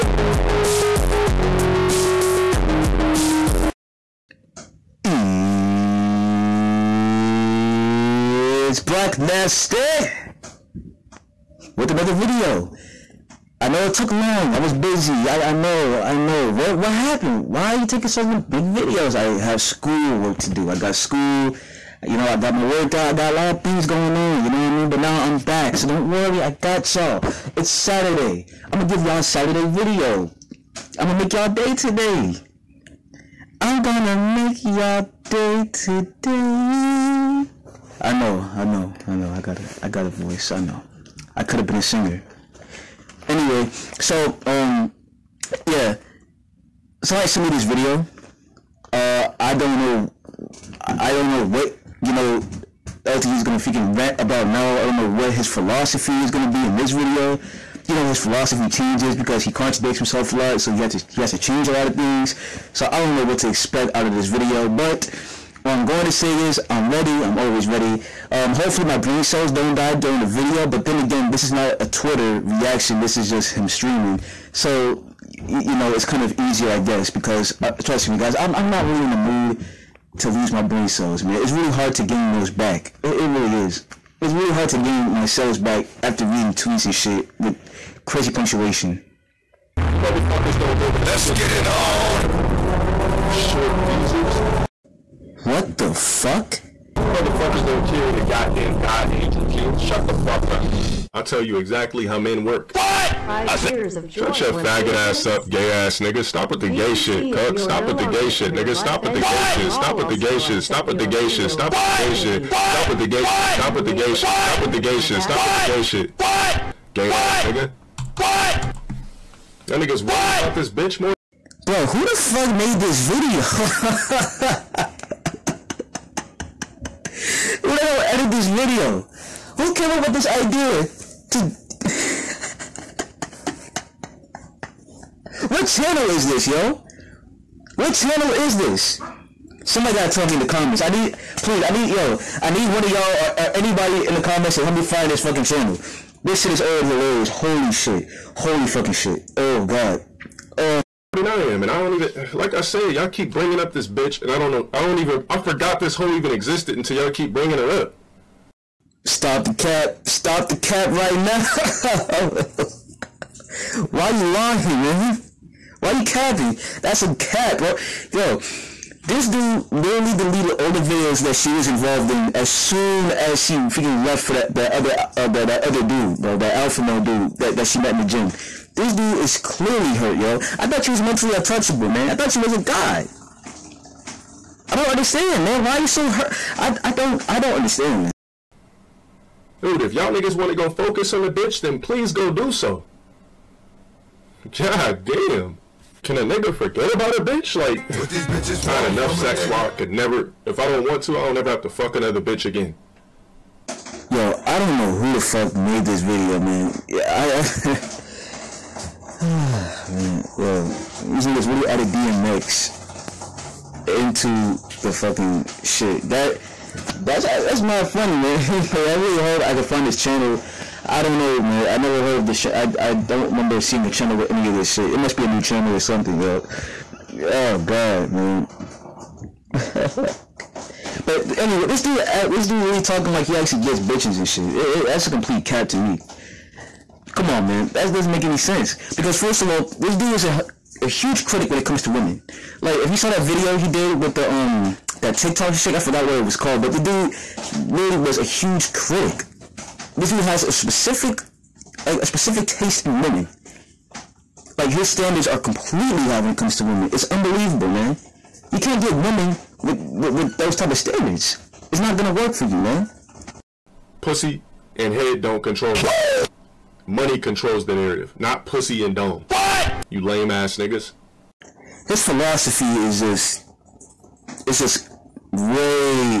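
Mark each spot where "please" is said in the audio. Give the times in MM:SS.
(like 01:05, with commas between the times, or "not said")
02:21, 03:11.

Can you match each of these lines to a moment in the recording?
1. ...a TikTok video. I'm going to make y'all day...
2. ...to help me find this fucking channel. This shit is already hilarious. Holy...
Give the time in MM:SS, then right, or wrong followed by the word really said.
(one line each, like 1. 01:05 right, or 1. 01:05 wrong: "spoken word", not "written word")
1. 00:29 wrong: "Saturday", not "TikTok"
2. 02:24 right.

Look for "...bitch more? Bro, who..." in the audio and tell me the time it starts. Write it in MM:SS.
02:00.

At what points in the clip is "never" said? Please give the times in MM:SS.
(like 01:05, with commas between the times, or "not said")
03:19, 03:41.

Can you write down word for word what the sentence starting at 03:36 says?
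That that's that's mad funny, man.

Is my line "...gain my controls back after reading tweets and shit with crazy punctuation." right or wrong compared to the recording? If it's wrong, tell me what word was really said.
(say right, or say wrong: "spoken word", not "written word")
wrong: "cells", not "controls".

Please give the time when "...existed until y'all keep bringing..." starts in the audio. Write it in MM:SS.
02:36.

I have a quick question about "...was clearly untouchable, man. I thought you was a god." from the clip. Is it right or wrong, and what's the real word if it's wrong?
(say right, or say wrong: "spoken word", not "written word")
wrong: "mentally", not "clearly".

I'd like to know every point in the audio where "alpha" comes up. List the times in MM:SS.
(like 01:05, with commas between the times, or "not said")
02:56.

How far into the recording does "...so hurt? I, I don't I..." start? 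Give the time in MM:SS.
03:05.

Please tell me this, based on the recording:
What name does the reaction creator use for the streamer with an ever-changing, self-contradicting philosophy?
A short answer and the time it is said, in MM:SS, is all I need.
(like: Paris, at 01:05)
LTG, at 00:53.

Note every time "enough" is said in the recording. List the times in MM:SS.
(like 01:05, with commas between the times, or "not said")
03:18.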